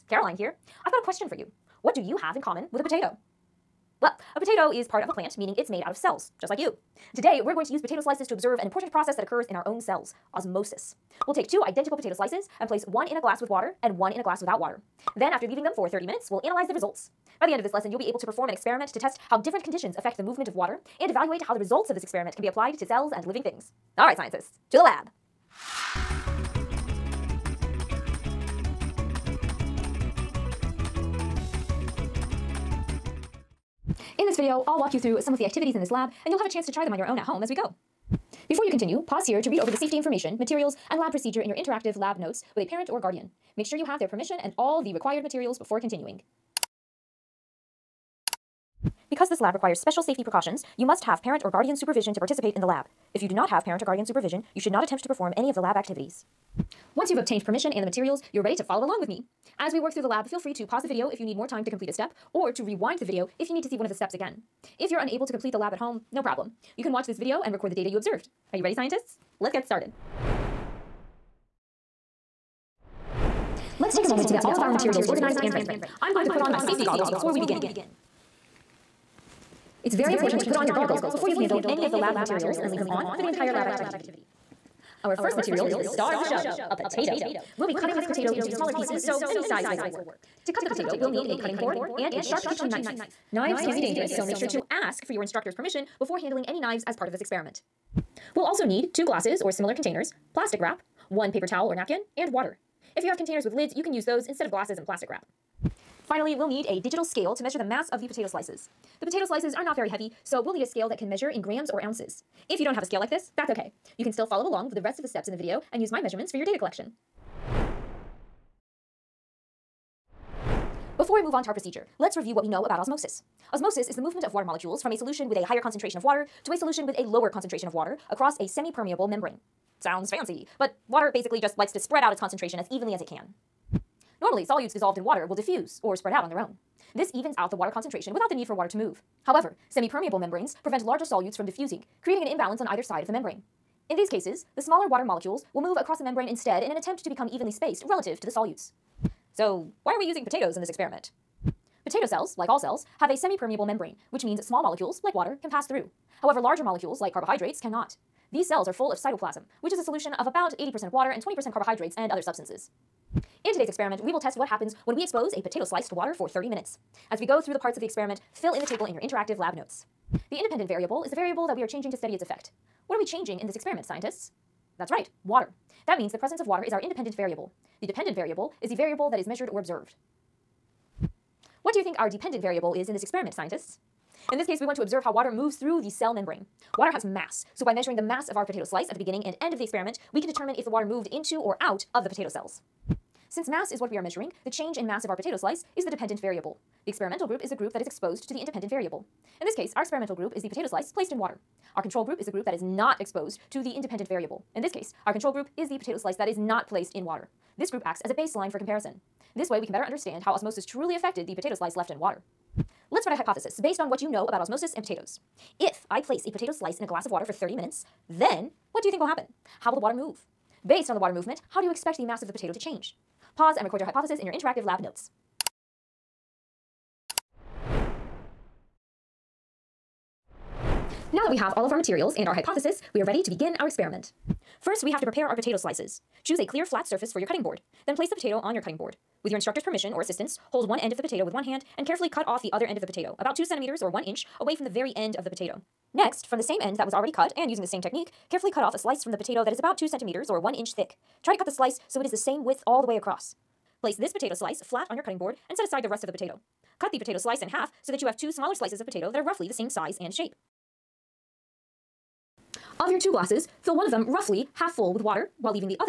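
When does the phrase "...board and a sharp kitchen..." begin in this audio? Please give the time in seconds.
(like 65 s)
91 s.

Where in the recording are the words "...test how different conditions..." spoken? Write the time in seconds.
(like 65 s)
18 s.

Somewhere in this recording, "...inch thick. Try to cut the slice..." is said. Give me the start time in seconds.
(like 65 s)
250 s.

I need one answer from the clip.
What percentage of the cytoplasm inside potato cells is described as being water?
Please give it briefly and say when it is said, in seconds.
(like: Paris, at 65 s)
80%, at 160 s.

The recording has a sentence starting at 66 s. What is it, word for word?
You can watch this video and record the data you observed.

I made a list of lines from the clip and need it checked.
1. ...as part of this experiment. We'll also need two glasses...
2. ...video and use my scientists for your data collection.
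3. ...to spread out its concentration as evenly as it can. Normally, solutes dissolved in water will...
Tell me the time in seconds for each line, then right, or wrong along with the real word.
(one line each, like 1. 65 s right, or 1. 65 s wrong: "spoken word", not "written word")
1. 96 s right
2. 115 s wrong: "measurements", not "scientists"
3. 131 s right.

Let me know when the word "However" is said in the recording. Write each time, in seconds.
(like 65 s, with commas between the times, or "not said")
139 s, 156 s.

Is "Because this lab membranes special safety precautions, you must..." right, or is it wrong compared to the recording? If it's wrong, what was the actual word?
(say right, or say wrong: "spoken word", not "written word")
wrong: "requires", not "membranes".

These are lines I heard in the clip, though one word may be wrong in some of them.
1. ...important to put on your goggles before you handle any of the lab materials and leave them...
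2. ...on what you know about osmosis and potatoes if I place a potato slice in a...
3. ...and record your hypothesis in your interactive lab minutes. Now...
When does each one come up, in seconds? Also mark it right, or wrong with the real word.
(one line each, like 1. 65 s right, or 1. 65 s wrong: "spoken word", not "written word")
1. 80 s right
2. 213 s right
3. 223 s wrong: "notes", not "minutes".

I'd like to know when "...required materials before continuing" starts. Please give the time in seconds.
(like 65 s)
44 s.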